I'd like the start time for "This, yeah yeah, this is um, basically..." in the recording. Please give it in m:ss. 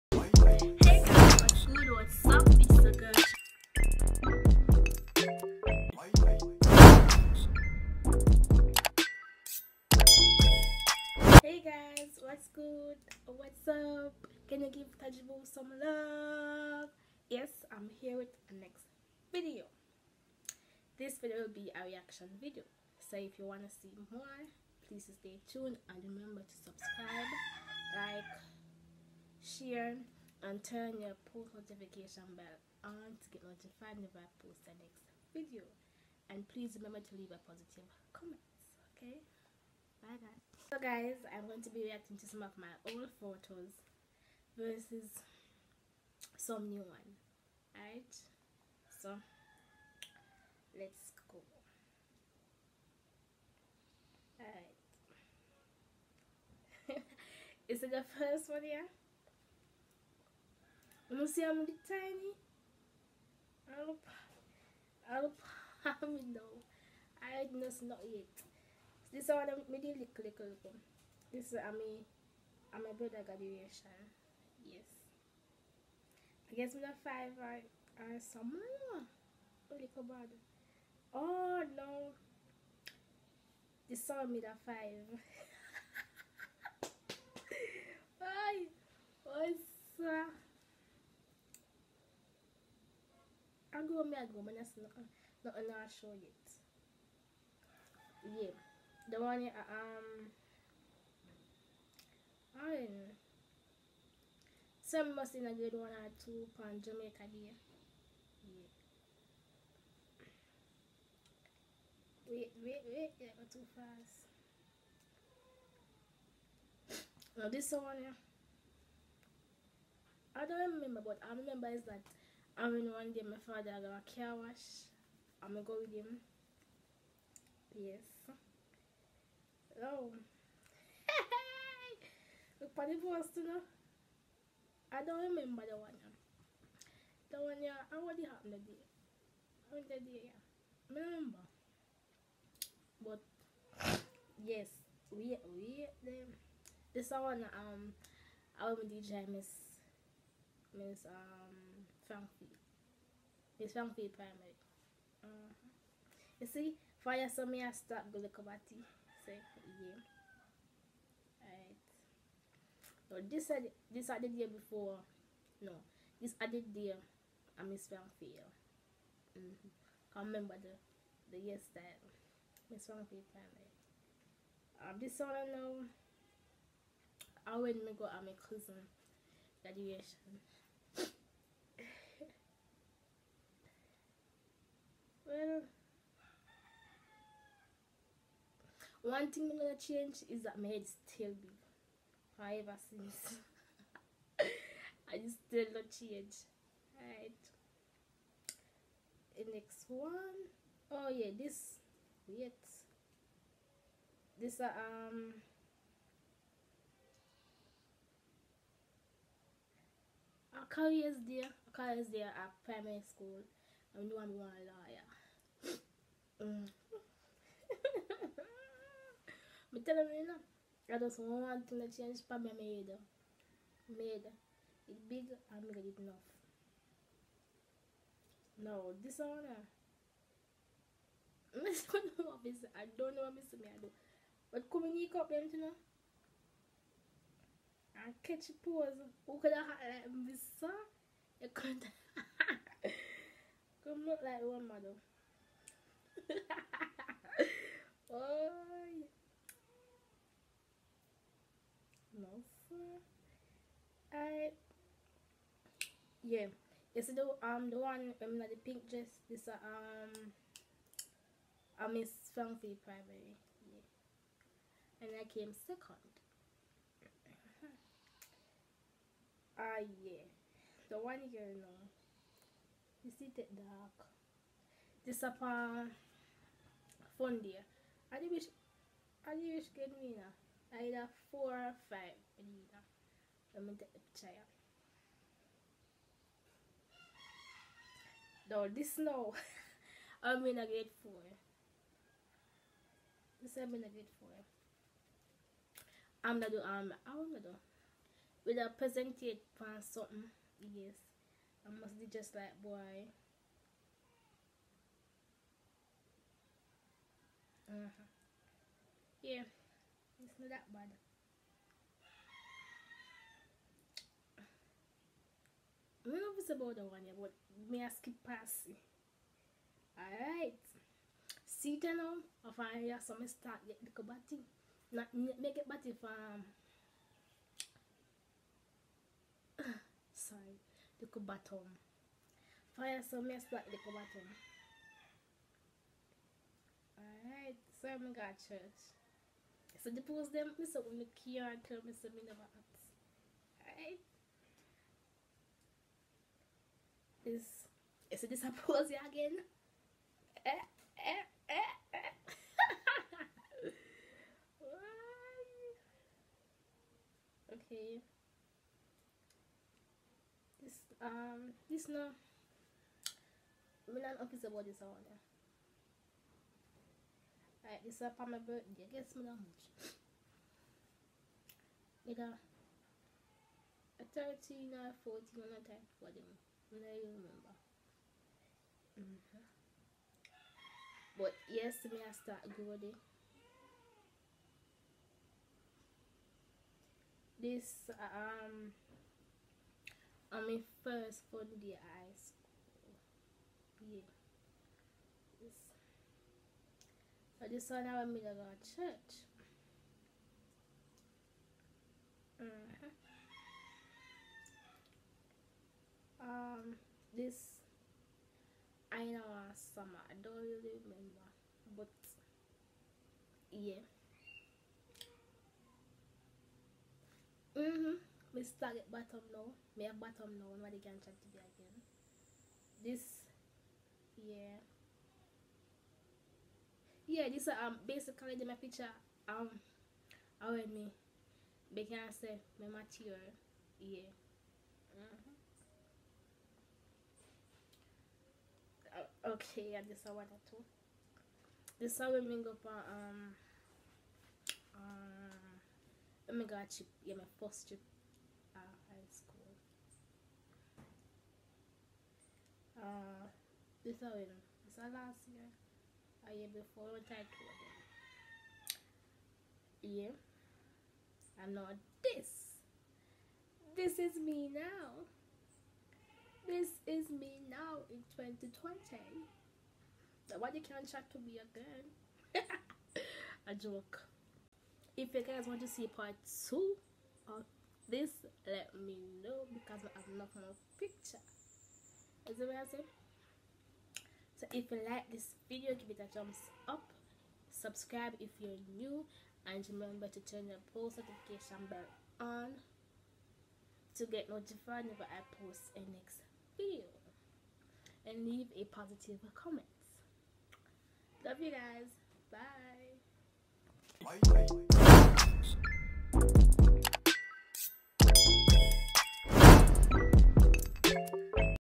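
7:02.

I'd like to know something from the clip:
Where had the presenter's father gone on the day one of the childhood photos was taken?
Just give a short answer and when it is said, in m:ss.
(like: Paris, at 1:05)
car wash, at 2:04.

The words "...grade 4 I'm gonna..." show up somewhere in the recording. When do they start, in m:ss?
4:53.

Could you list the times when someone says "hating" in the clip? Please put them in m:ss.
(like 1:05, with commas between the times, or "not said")
not said.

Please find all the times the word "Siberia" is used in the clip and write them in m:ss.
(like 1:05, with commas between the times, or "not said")
not said.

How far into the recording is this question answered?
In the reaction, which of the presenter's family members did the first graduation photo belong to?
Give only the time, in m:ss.
1:12.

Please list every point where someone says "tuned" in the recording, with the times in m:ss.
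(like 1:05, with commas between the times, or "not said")
0:25.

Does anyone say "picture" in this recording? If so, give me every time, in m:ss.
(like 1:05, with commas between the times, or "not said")
7:08, 8:00.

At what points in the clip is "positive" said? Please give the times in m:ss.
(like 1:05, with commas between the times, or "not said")
0:37, 8:18.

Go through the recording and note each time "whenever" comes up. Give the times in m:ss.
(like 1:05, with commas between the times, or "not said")
0:33, 8:14.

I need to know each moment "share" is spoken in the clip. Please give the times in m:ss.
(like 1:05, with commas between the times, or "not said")
0:29.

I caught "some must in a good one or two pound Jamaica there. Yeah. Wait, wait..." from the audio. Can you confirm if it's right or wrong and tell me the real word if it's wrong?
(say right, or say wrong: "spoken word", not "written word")
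right.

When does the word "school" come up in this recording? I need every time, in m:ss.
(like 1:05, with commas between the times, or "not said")
3:33, 6:32, 7:29.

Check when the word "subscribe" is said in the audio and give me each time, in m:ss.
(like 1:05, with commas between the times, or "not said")
0:26, 8:07.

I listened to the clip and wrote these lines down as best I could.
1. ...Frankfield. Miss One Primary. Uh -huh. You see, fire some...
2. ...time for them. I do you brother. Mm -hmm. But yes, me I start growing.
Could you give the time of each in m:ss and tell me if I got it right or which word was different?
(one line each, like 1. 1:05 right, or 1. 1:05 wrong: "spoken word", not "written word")
1. 2:32 wrong: "Frankfield", not "One"
2. 6:15 wrong: "remember", not "brother".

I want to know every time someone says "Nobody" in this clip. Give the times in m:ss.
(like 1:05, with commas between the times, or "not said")
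7:00, 7:50.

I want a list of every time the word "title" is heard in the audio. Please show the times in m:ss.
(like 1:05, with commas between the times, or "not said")
7:37.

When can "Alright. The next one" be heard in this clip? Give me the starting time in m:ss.
3:16.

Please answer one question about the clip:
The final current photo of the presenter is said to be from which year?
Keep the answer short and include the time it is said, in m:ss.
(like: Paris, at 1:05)
2020, at 7:48.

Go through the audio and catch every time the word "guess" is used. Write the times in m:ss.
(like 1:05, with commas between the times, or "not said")
1:16, 6:08.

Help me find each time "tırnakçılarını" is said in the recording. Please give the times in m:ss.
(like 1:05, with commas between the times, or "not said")
3:41.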